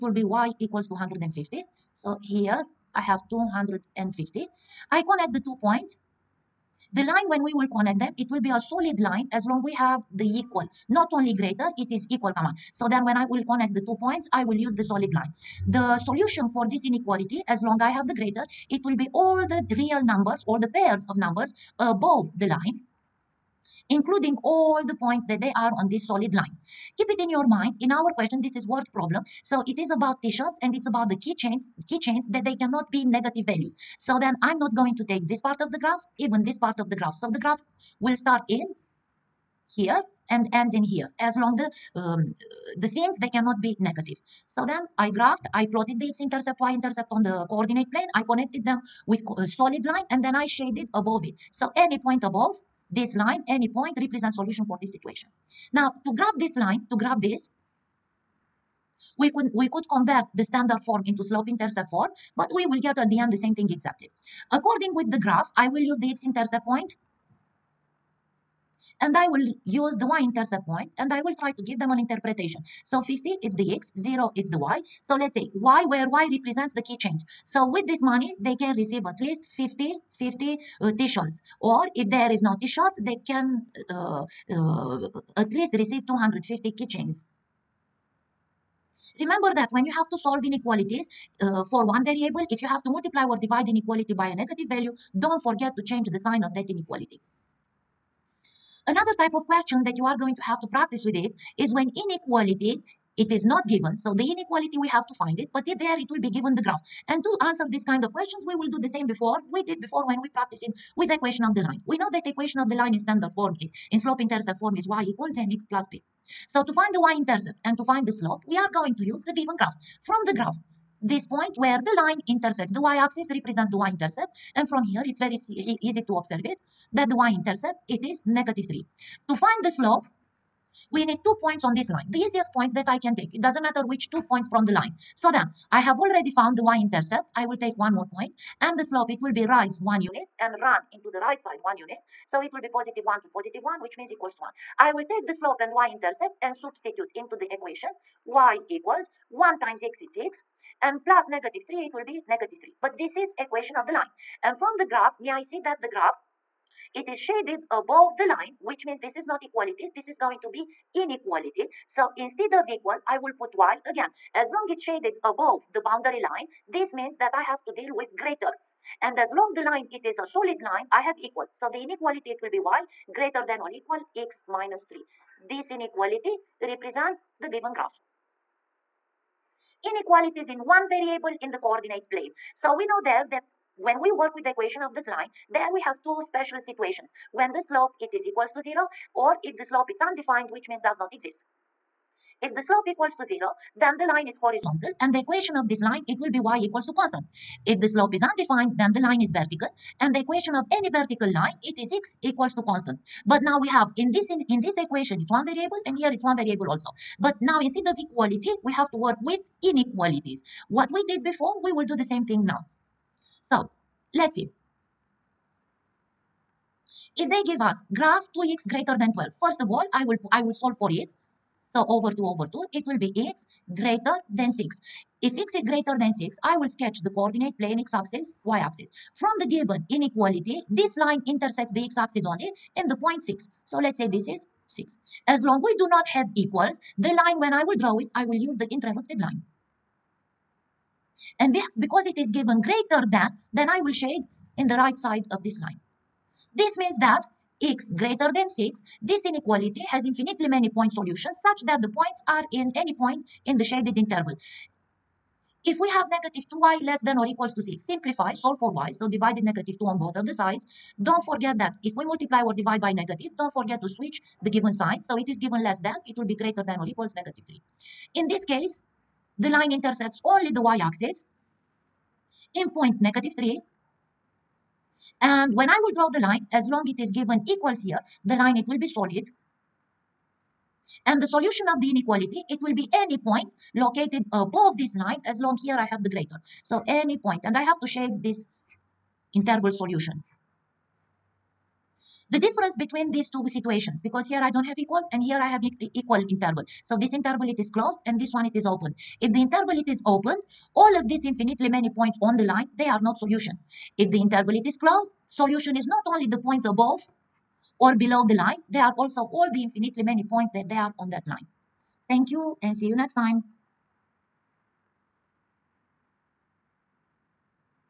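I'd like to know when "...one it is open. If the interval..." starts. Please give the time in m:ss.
4:58.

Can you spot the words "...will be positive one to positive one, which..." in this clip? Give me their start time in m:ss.
2:22.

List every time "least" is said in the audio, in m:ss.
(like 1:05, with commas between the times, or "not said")
1:19, 1:25.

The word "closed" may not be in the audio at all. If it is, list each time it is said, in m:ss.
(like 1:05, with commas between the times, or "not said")
4:57, 5:04.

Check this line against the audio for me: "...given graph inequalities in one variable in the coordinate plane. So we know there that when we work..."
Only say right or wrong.
right.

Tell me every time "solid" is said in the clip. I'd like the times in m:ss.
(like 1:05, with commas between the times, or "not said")
0:08, 0:14, 0:26, 0:49, 2:50, 4:38.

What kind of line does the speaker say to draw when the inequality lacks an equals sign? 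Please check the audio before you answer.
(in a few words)
Interrupted line.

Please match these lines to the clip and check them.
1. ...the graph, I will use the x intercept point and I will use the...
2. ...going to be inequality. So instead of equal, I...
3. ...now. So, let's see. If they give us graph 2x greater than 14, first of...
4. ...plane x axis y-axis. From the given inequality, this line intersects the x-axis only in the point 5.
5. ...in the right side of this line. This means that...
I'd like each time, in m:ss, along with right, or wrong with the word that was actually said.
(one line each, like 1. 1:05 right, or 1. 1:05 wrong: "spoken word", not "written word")
1. 1:05 right
2. 2:40 right
3. 3:32 wrong: "12", not "14"
4. 3:47 wrong: "6", not "5"
5. 4:04 right.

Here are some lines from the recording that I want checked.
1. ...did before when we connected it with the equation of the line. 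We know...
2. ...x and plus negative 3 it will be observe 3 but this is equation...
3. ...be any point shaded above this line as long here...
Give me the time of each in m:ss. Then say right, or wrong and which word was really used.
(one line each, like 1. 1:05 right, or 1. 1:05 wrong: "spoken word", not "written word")
1. 1:49 wrong: "practiced", not "connected"
2. 2:30 wrong: "negative", not "observe"
3. 4:42 wrong: "located", not "shaded".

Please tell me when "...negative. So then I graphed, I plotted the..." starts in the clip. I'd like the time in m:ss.
0:43.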